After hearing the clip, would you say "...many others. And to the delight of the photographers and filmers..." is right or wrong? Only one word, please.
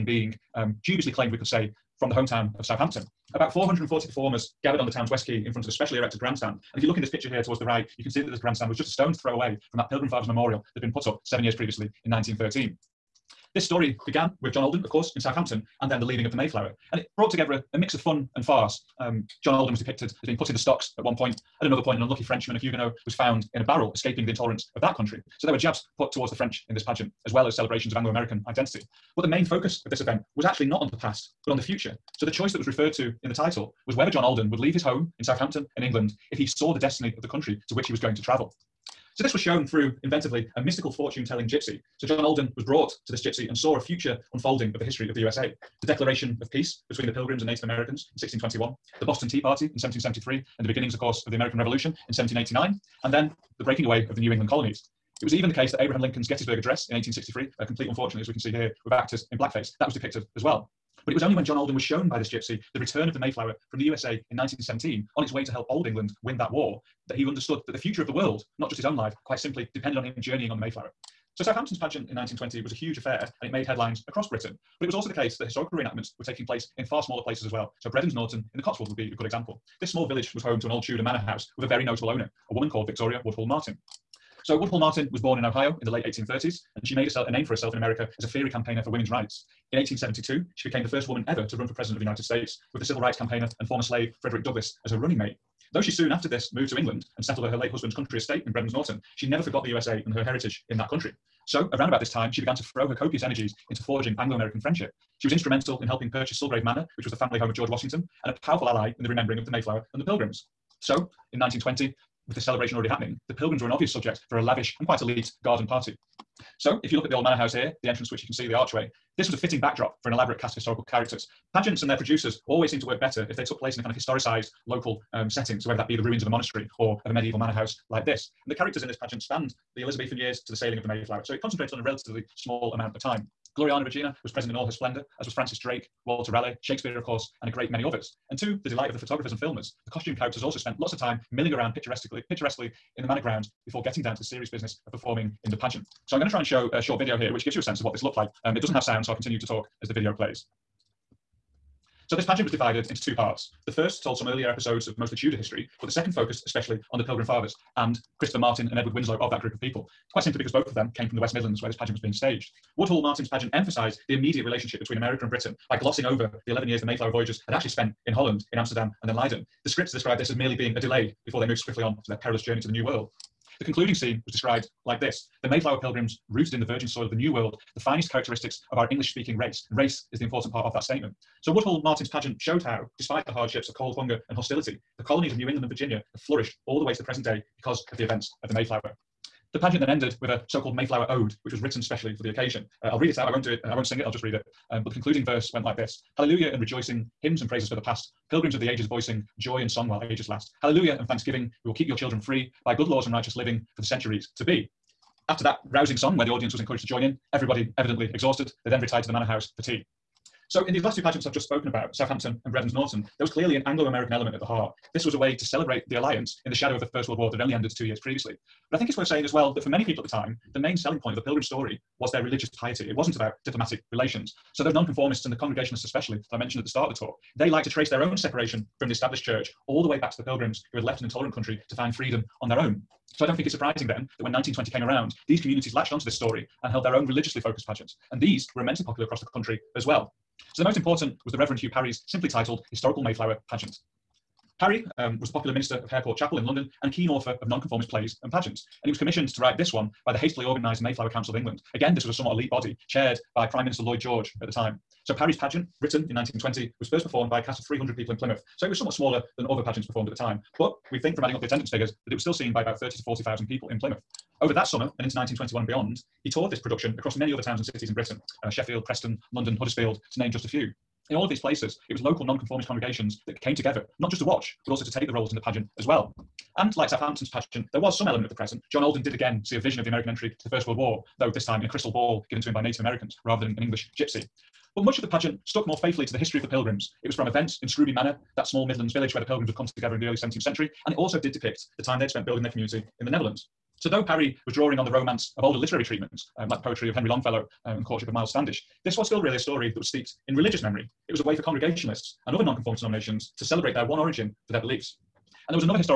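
right.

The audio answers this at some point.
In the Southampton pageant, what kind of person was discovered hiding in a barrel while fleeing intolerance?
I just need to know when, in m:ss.
0:22.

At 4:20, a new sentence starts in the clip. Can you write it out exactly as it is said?
But we think from adding up the attendance figures that it was still seen by about 30 to 40,000 people in Plymouth.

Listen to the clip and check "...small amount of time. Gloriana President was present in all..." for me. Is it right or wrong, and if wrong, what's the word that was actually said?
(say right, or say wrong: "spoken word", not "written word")
wrong: "Regina", not "President".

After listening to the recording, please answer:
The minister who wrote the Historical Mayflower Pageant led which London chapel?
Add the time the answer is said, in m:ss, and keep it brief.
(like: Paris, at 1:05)
Hare Court Chapel, at 4:05.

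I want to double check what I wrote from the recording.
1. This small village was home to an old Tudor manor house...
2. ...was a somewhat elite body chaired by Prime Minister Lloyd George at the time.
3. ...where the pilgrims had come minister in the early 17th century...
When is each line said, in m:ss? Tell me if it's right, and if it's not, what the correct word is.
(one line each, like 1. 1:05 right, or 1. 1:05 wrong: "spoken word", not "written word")
1. 1:19 right
2. 4:12 right
3. 4:49 wrong: "together", not "minister".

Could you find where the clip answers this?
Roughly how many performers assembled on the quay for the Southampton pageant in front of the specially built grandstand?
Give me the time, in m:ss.
0:03.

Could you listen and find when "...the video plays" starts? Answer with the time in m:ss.
2:29.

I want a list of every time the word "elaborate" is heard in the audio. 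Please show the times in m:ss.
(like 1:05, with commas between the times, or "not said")
2:00.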